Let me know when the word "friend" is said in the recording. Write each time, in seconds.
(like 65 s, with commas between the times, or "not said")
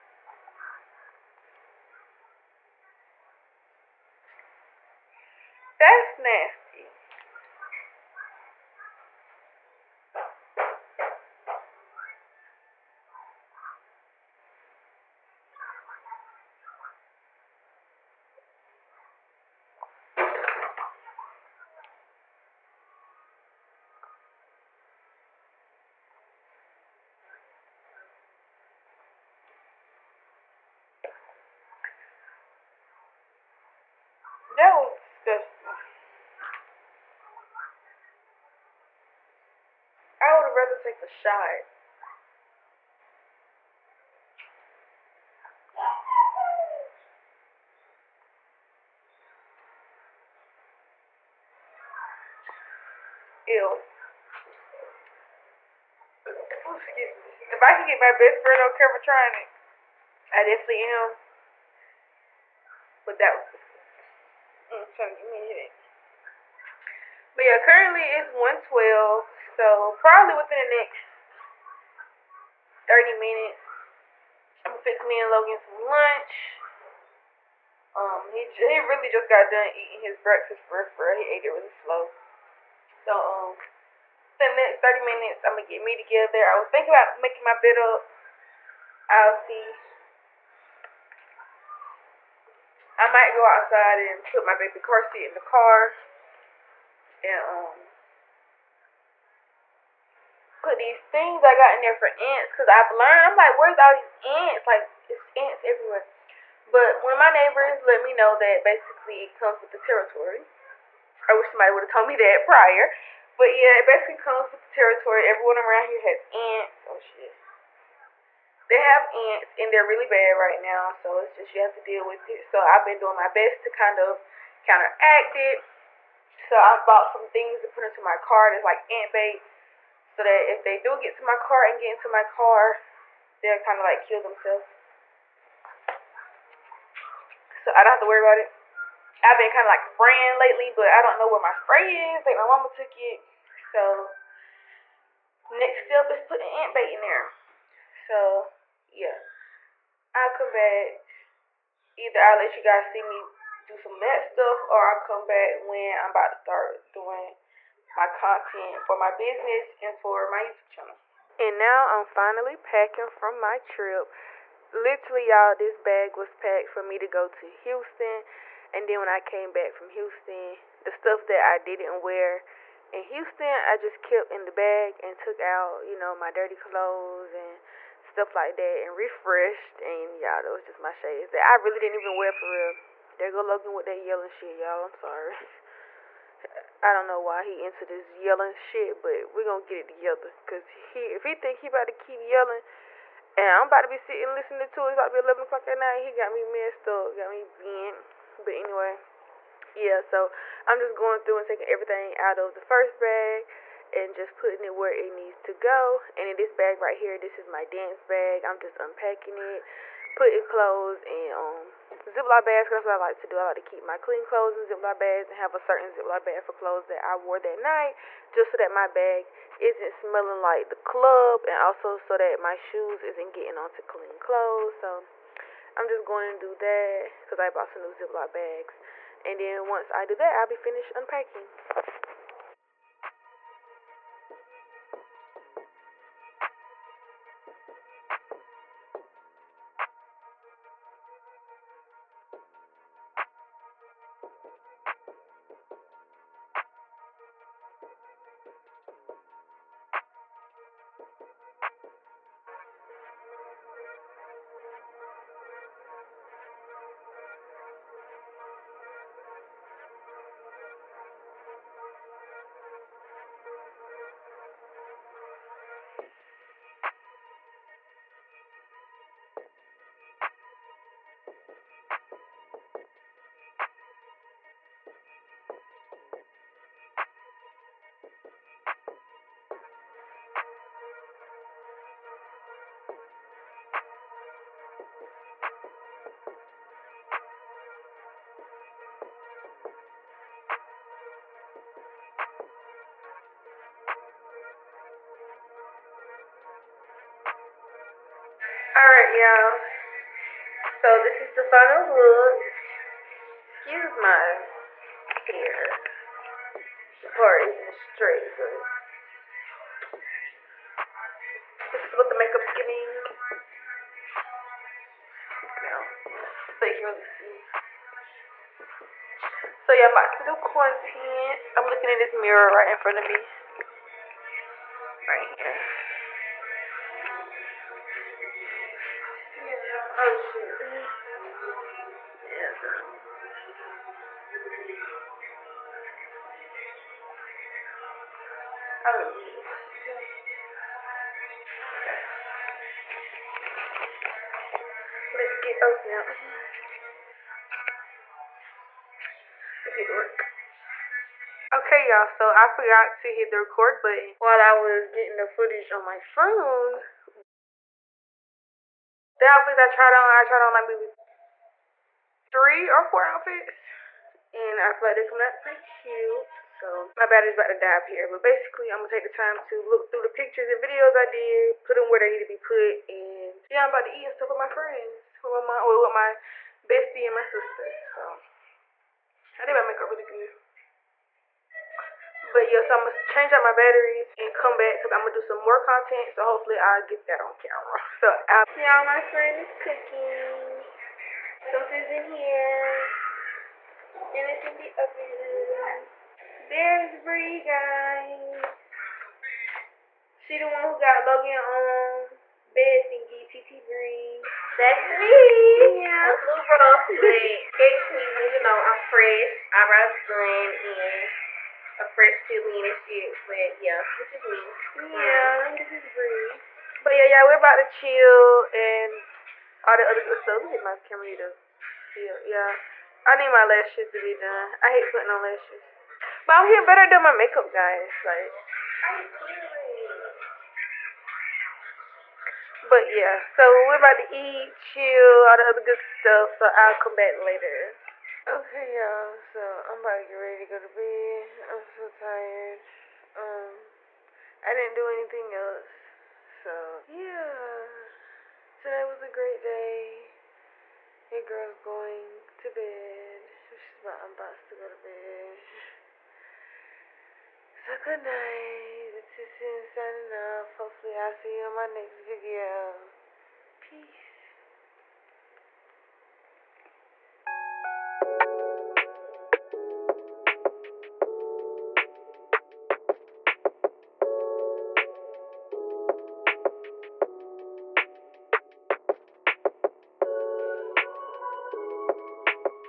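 58 s, 374 s, 389 s.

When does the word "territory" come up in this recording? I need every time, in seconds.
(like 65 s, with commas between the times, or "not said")
109 s, 114 s.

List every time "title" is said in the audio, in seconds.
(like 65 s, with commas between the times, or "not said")
not said.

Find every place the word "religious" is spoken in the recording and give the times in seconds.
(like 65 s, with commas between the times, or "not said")
not said.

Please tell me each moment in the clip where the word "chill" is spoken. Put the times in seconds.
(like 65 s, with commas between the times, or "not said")
417 s, 434 s.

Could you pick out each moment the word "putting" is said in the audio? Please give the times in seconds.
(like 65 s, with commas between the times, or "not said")
146 s, 204 s, 210 s, 424 s.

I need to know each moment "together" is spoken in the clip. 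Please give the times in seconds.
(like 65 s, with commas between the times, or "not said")
85 s, 189 s.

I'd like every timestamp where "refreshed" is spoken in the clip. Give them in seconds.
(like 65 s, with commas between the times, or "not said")
178 s.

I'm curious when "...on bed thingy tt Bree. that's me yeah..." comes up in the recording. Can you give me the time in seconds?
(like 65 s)
401 s.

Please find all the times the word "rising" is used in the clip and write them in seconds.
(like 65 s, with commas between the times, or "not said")
not said.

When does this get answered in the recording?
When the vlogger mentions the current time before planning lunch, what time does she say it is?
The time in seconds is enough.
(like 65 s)
68 s.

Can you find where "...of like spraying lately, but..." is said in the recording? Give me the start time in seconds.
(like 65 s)
139 s.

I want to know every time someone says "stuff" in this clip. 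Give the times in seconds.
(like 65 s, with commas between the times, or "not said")
154 s, 170 s, 178 s, 374 s, 420 s, 435 s.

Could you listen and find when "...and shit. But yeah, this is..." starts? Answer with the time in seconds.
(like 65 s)
412 s.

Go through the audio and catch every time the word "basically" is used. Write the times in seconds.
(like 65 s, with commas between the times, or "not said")
108 s, 113 s, 368 s.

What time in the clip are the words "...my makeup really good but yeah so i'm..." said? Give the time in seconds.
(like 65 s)
379 s.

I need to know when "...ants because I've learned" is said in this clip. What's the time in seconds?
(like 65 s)
102 s.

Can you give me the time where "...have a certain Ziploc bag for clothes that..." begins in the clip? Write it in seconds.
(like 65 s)
215 s.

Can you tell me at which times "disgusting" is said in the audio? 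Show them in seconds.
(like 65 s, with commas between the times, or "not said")
34 s, 63 s.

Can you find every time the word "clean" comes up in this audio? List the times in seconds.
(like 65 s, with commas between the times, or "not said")
213 s, 223 s.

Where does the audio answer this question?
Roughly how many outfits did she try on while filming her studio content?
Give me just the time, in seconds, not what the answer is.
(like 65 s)
362 s.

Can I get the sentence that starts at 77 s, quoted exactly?
Um, he he really just got done eating his breakfast for for he ate it really slow.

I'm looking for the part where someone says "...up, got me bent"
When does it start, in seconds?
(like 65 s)
196 s.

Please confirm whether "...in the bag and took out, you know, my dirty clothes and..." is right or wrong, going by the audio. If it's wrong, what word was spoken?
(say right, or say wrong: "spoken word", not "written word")
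right.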